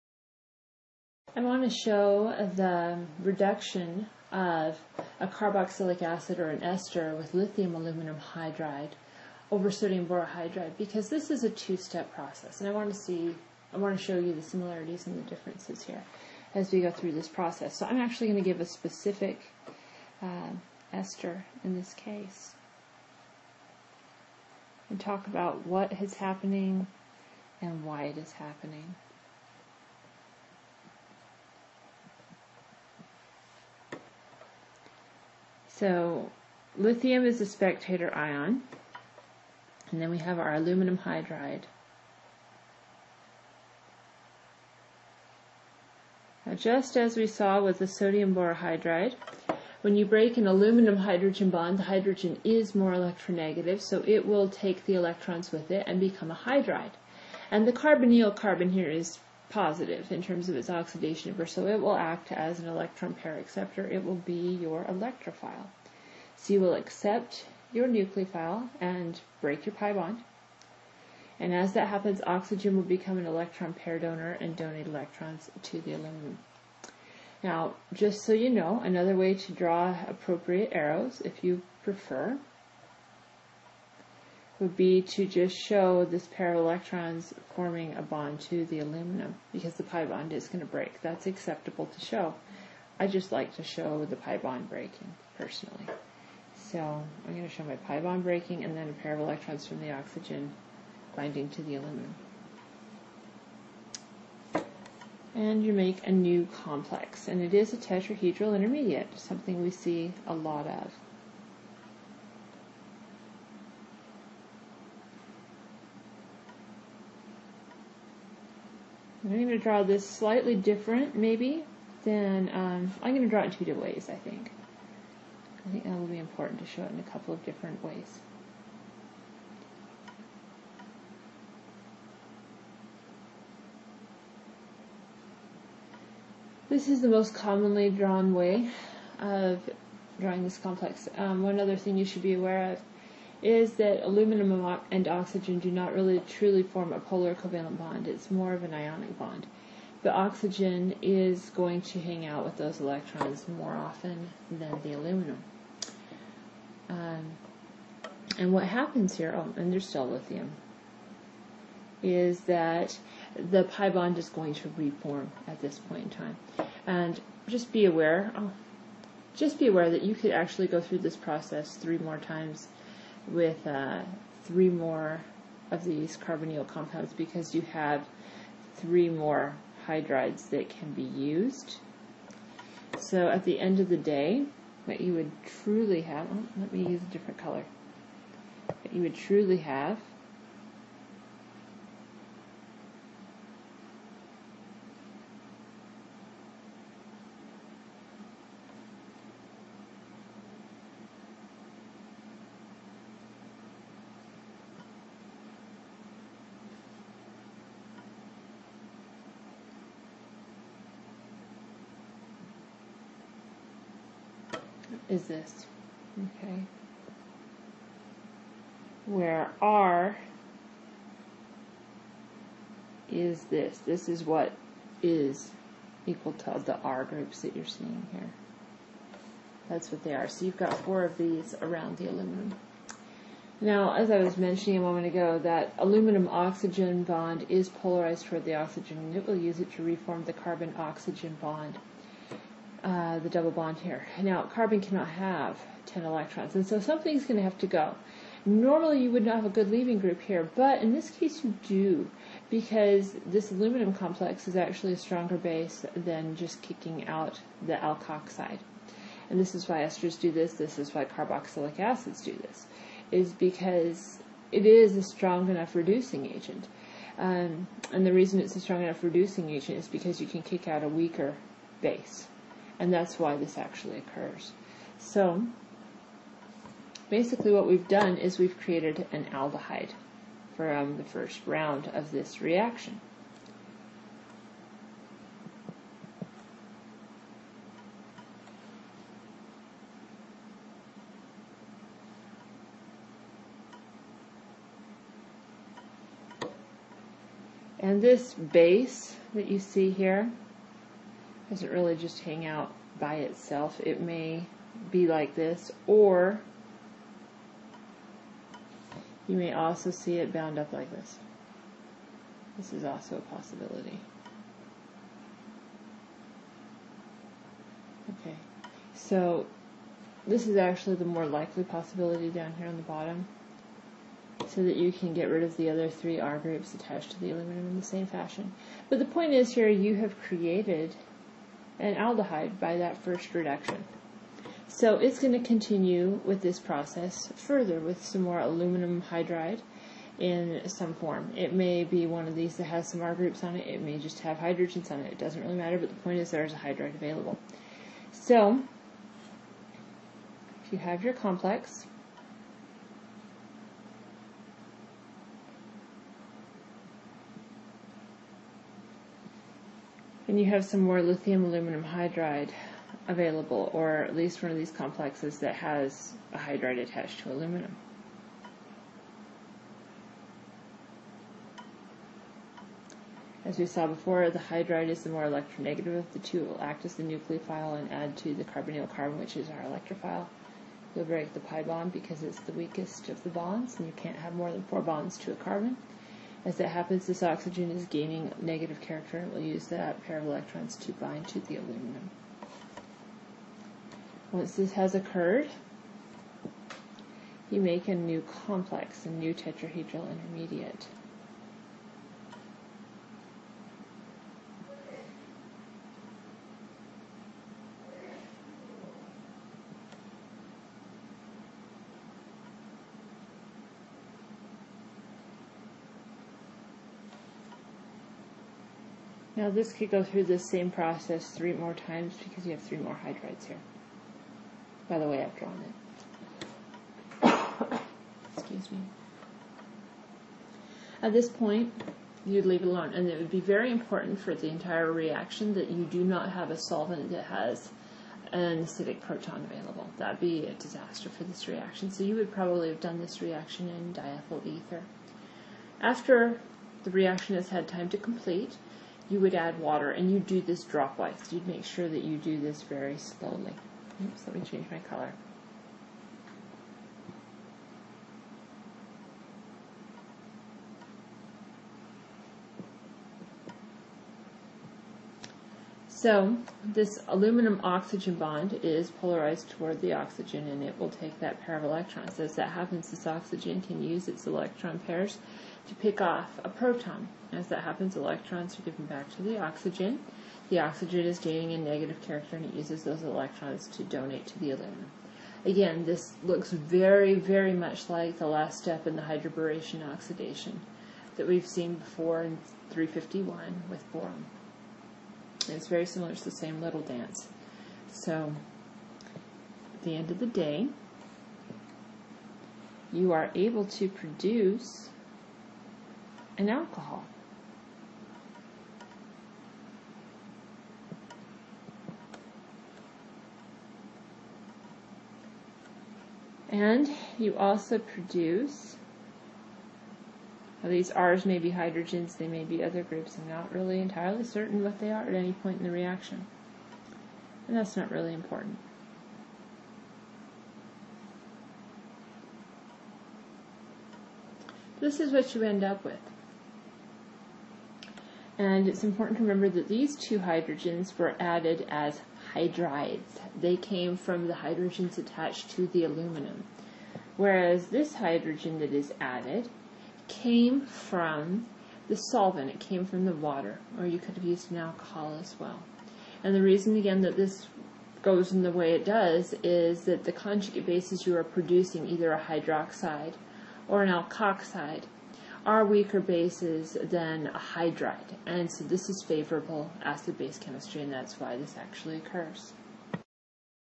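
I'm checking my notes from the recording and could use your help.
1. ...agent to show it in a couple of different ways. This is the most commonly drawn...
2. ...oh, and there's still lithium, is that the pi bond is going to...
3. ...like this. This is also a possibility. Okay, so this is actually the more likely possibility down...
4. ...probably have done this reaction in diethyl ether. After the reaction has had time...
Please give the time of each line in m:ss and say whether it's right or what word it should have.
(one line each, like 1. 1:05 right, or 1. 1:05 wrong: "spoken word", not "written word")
1. 2:06 wrong: "important", not "agent"
2. 2:39 right
3. 5:10 right
4. 7:22 right.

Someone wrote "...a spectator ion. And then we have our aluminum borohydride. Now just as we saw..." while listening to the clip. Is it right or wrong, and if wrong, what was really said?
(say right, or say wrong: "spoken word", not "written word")
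wrong: "hydride", not "borohydride".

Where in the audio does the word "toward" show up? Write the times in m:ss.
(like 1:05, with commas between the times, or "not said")
3:58, 7:49.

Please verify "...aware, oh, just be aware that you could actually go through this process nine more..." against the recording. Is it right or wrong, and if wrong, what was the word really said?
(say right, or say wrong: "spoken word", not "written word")
wrong: "three", not "nine".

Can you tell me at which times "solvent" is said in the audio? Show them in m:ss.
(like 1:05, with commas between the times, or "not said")
7:16, 9:11.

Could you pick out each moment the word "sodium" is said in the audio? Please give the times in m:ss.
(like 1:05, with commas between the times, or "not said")
0:09, 0:47.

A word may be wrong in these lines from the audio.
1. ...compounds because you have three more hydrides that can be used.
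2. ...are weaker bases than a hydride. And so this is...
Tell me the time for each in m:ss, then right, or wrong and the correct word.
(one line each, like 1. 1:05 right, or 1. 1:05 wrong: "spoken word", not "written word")
1. 2:56 right
2. 9:25 right.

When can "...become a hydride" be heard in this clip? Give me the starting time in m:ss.
0:55.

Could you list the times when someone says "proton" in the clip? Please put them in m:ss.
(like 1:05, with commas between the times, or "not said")
7:19, 7:56.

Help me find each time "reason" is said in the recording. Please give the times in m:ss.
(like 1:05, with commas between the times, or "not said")
4:28, 9:16.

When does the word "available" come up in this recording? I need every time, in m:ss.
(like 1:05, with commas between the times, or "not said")
5:46, 6:03, 7:19.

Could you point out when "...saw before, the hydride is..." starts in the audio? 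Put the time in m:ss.
6:13.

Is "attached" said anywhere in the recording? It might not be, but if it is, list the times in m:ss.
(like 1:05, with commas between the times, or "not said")
5:26, 6:06, 9:04.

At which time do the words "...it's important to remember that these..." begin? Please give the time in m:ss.
8:58.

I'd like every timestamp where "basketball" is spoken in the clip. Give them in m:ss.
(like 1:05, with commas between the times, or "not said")
not said.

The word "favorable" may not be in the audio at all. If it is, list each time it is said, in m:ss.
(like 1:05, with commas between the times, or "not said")
9:29.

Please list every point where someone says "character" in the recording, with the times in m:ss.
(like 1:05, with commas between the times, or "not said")
6:28, 8:02.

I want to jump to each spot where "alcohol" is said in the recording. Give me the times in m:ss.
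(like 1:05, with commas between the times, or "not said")
8:26, 9:14.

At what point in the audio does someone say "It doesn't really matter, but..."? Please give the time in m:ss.
5:45.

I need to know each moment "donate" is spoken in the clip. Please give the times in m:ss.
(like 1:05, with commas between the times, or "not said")
1:14, 8:03.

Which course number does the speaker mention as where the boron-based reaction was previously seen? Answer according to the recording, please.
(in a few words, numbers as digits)
351.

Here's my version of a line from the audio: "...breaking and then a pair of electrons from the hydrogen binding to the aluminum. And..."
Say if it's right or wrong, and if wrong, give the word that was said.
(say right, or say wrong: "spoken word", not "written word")
wrong: "oxygen", not "hydrogen".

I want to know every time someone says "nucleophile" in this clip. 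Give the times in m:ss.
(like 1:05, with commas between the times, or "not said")
1:07, 6:17.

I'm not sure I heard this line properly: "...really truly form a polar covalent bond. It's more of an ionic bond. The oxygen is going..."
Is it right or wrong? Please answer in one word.
right.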